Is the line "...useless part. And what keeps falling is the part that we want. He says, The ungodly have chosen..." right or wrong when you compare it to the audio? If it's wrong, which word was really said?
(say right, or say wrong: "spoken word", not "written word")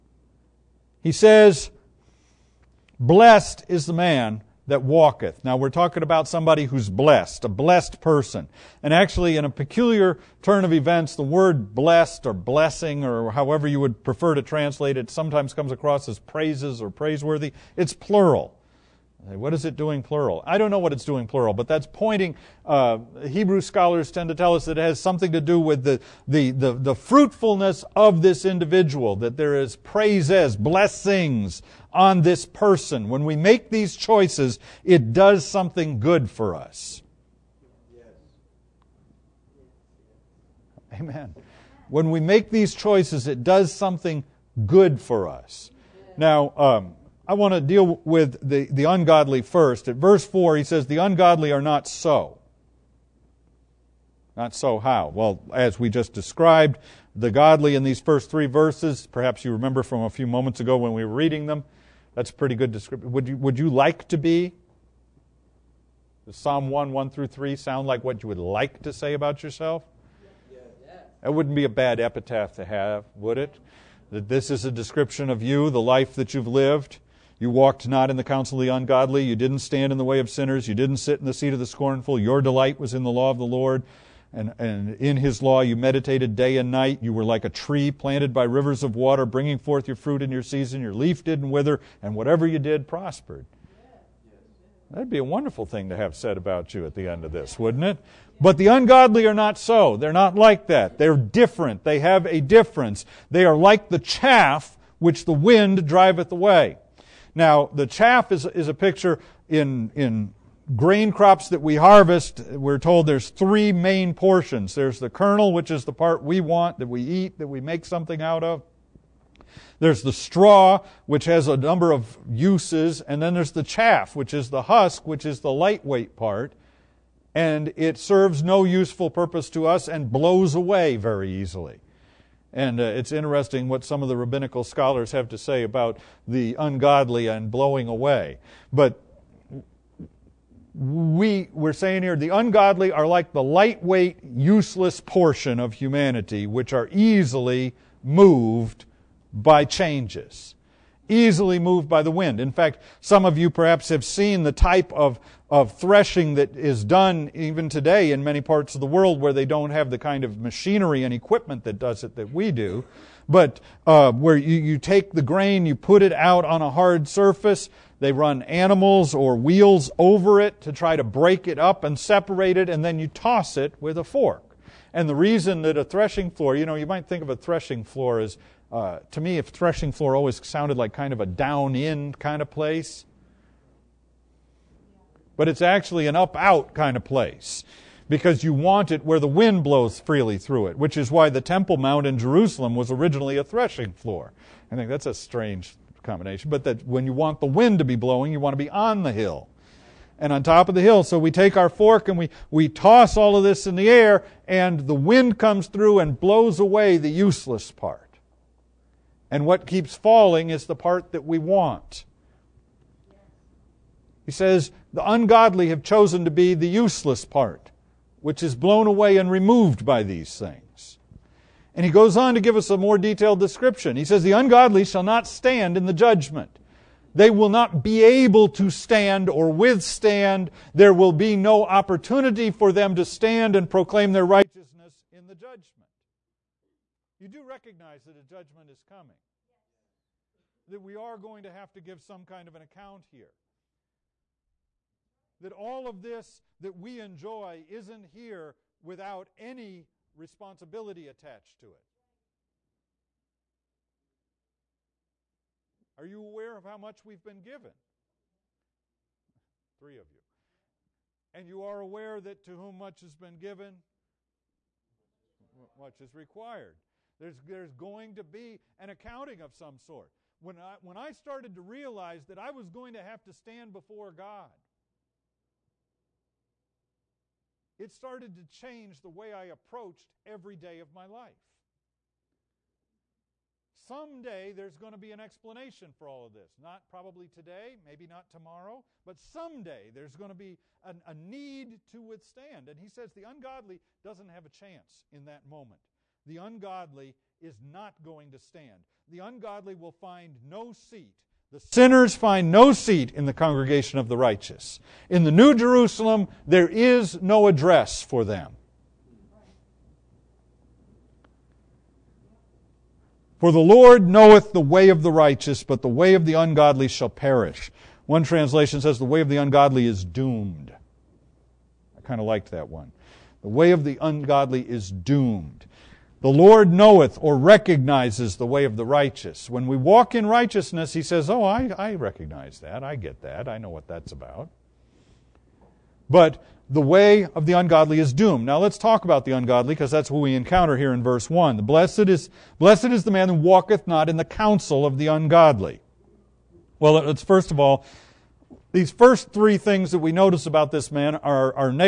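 right.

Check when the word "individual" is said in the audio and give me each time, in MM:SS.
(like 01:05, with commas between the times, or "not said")
00:28.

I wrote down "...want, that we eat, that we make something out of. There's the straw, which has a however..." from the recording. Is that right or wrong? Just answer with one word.
wrong.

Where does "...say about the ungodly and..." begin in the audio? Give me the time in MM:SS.
02:15.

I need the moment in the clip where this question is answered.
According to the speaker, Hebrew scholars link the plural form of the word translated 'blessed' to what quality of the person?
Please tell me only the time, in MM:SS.
00:26.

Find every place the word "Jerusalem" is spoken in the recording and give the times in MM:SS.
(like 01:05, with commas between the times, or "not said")
03:12, 05:05.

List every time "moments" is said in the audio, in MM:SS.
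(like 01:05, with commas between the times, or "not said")
01:00, 04:55.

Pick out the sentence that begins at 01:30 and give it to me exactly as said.
Your leaf didn't wither, and whatever you did prospered.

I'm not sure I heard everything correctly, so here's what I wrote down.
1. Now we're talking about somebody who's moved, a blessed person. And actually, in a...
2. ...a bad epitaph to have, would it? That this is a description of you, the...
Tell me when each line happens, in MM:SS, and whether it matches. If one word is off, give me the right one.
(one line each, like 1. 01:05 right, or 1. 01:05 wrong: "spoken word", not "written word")
1. 00:05 wrong: "blessed", not "moved"
2. 01:11 right.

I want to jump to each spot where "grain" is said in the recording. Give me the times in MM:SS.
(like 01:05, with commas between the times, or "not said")
01:50, 02:45.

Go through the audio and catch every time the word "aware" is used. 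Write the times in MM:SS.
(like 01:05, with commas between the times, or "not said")
04:16, 04:21.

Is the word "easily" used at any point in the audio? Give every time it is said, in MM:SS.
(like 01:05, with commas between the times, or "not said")
02:11, 02:26, 02:31.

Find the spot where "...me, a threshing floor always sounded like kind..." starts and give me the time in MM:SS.
02:59.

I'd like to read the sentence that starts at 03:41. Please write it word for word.
And he goes on to give us a more detailed description.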